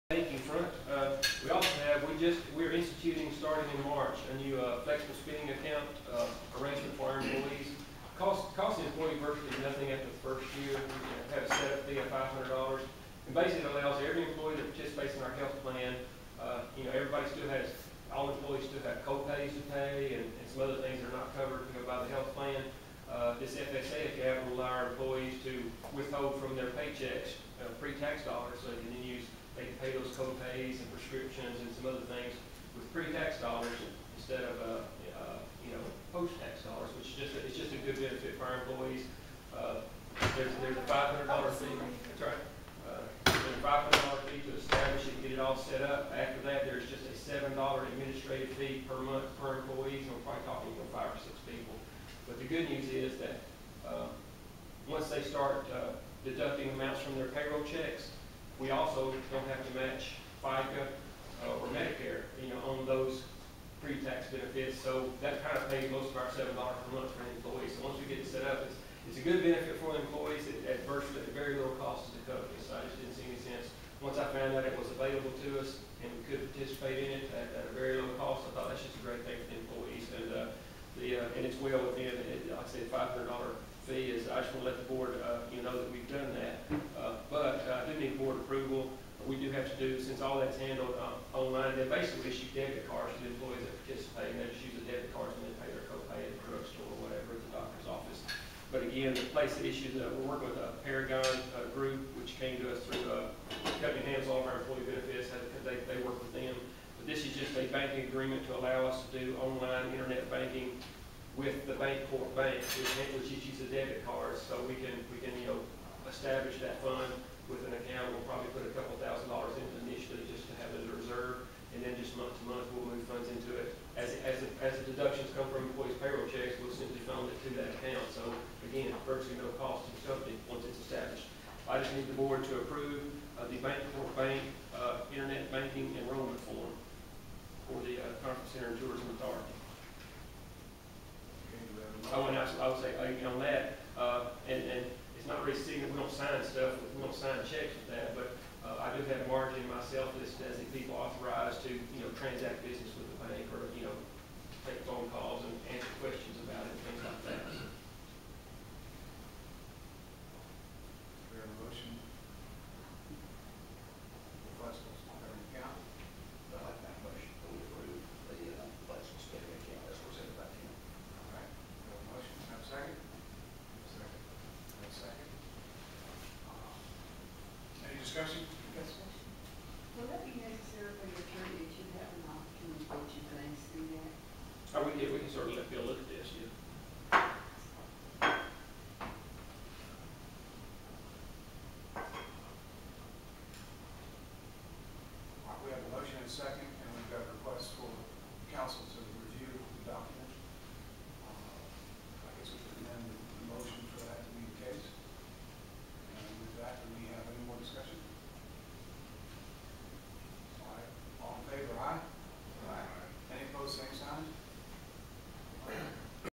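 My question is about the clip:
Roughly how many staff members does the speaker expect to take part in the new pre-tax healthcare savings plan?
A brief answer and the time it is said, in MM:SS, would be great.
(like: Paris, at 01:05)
5 or 6, at 00:50.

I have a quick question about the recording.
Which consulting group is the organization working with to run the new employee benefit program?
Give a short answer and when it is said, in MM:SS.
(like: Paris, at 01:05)
Paragon, at 01:40.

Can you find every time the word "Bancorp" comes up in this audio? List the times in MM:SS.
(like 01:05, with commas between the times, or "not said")
01:51, 02:13.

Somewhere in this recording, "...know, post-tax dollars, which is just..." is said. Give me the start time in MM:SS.
00:35.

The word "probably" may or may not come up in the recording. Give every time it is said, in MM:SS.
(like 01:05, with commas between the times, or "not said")
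00:50, 01:58.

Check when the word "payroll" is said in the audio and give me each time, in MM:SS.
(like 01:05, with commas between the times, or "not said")
00:57, 02:05.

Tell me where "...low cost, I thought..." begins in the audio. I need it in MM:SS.
01:18.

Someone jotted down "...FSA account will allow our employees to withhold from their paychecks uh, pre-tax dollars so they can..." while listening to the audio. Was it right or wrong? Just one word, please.
right.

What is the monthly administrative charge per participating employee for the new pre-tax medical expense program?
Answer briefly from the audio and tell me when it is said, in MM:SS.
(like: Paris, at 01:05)
$7, at 00:47.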